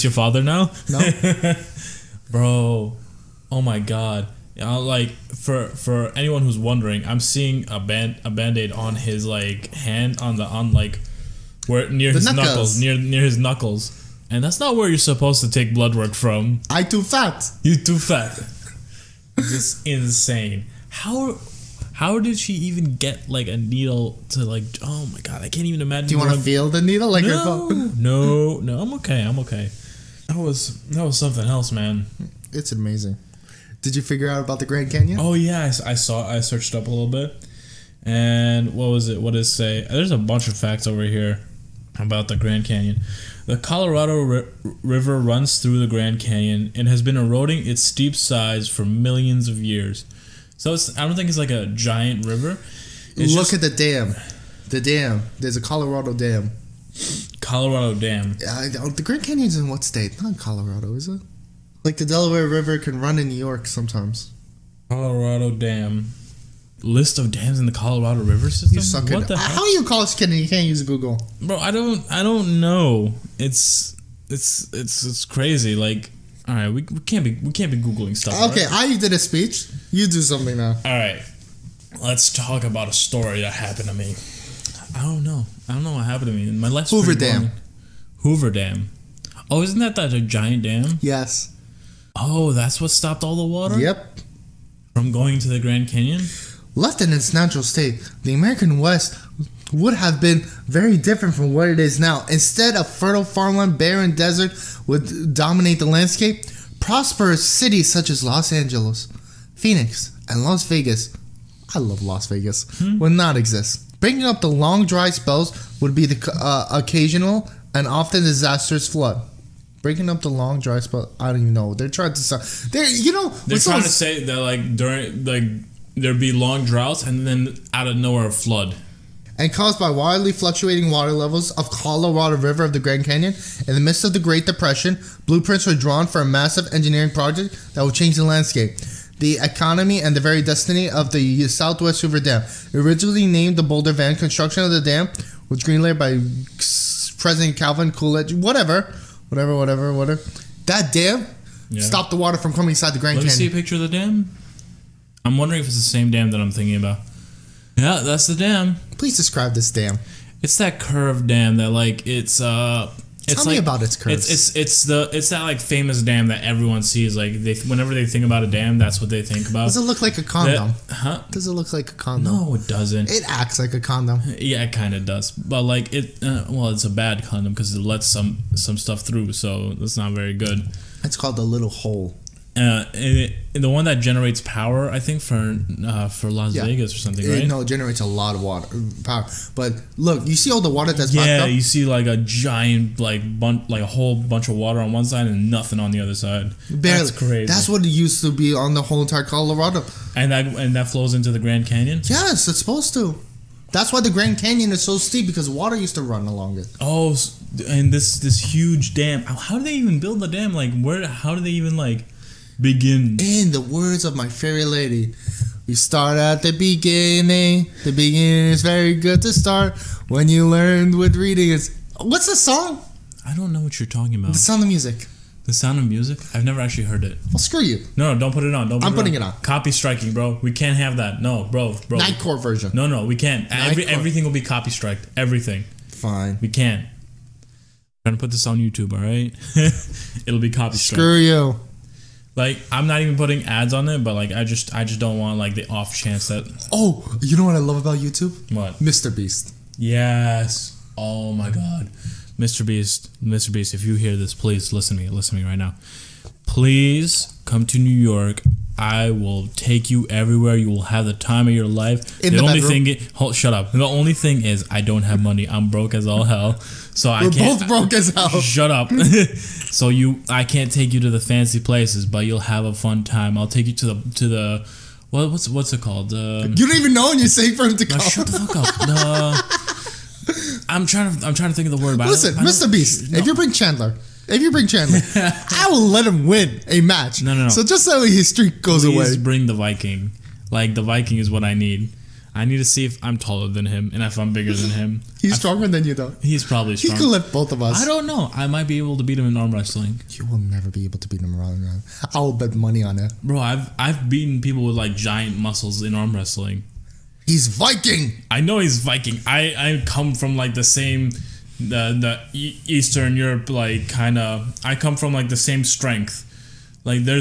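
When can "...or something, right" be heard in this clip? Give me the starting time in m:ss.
3:06.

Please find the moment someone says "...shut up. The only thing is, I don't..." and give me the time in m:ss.
4:23.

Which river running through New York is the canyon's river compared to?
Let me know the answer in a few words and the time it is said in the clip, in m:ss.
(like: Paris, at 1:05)
Delaware River, at 1:02.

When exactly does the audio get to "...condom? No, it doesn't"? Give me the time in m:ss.
2:51.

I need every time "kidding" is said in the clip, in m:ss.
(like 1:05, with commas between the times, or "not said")
1:10.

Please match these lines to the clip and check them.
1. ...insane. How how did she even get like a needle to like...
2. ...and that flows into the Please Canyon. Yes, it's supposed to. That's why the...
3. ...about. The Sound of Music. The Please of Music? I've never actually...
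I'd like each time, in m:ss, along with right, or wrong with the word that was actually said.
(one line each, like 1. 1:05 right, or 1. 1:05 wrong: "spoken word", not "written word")
1. 0:19 right
2. 3:20 wrong: "Grand", not "Please"
3. 3:44 wrong: "Sound", not "Please".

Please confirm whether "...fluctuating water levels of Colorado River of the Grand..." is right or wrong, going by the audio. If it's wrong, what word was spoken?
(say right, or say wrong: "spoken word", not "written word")
right.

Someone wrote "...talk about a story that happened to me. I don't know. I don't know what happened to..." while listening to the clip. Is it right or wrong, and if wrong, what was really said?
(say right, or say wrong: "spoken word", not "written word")
right.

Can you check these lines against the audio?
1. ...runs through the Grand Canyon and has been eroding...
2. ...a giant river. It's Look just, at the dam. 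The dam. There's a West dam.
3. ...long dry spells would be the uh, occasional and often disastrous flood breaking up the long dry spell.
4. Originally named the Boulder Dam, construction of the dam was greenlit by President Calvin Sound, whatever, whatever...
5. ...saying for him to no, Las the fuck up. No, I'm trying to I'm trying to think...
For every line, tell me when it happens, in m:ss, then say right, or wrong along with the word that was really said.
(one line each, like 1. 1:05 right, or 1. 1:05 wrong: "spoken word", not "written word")
1. 0:45 right
2. 0:51 wrong: "Colorado", not "West"
3. 1:54 right
4. 2:22 wrong: "Coolidge", not "Sound"
5. 4:37 wrong: "Shut", not "Las".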